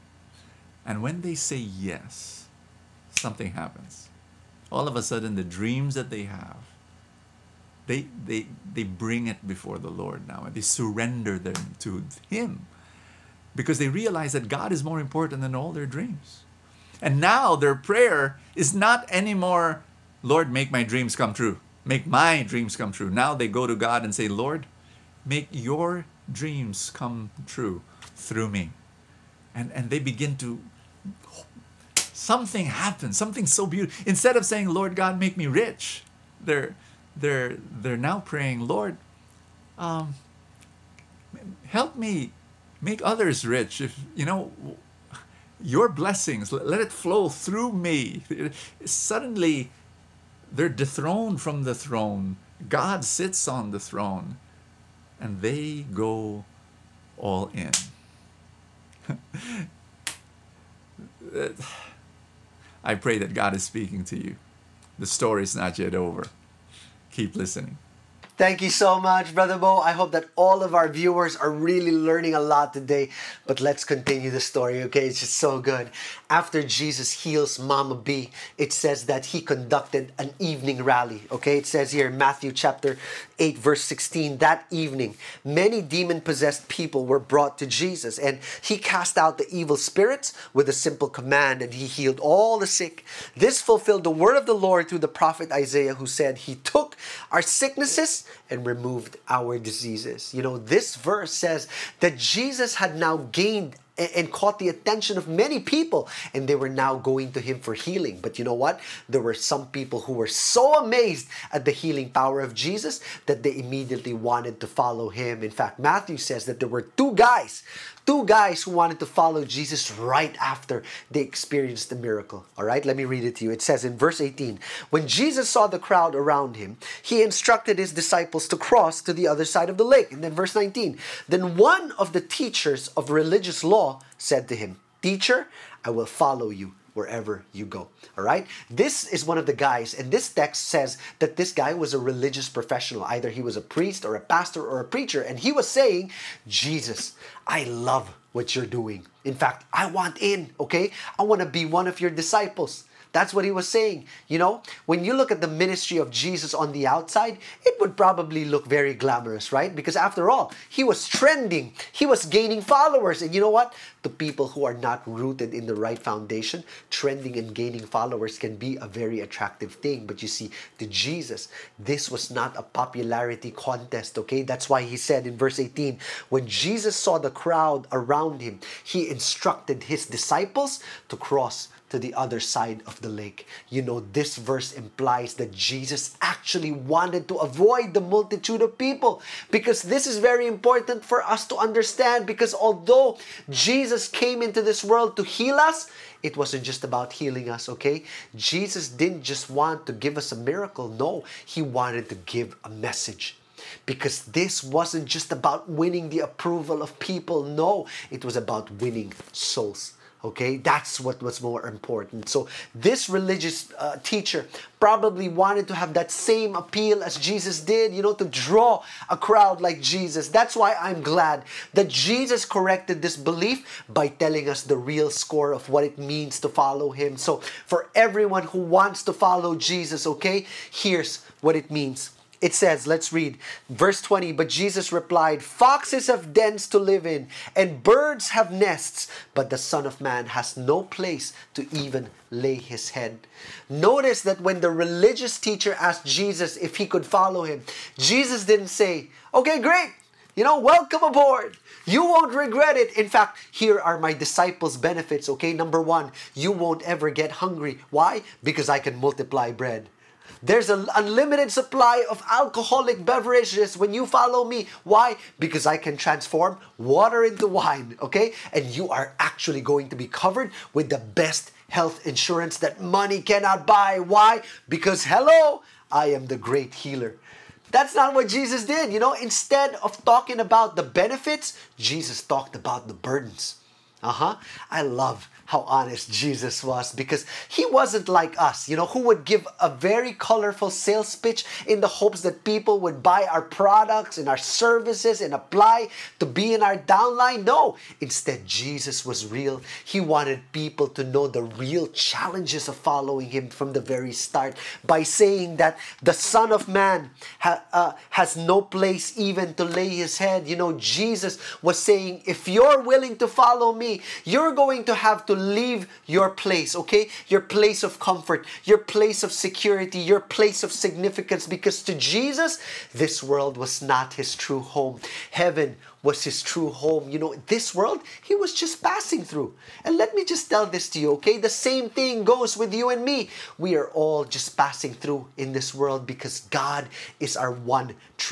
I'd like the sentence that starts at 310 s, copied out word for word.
You know, Jesus was saying, if you're willing to follow me, you're going to have to leave your place, okay?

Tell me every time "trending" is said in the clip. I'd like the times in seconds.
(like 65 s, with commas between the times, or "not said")
161 s, 166 s.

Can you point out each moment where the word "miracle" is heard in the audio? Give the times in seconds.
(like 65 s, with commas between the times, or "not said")
121 s, 200 s.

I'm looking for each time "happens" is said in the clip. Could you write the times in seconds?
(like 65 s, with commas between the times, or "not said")
3 s, 32 s.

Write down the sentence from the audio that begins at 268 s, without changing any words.
And you are actually going to be covered with the best health insurance that money cannot buy.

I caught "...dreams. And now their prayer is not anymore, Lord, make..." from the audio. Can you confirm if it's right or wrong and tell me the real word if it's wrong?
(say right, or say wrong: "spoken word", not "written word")
right.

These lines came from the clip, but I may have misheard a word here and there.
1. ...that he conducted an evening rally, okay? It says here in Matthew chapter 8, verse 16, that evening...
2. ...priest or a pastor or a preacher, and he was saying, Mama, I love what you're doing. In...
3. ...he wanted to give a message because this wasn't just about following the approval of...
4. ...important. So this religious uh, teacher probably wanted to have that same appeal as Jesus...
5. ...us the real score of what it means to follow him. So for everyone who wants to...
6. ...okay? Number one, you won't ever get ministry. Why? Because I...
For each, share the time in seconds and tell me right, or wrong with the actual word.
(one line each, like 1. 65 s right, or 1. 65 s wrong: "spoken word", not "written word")
1. 79 s right
2. 143 s wrong: "Jesus", not "Mama"
3. 201 s wrong: "winning", not "following"
4. 211 s right
5. 224 s right
6. 255 s wrong: "hungry", not "ministry".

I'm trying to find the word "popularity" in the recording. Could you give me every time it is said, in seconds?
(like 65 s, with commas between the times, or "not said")
172 s.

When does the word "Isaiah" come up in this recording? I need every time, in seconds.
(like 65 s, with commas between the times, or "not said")
95 s.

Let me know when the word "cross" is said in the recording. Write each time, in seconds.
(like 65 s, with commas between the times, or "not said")
128 s, 181 s.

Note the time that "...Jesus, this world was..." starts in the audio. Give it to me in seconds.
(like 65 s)
321 s.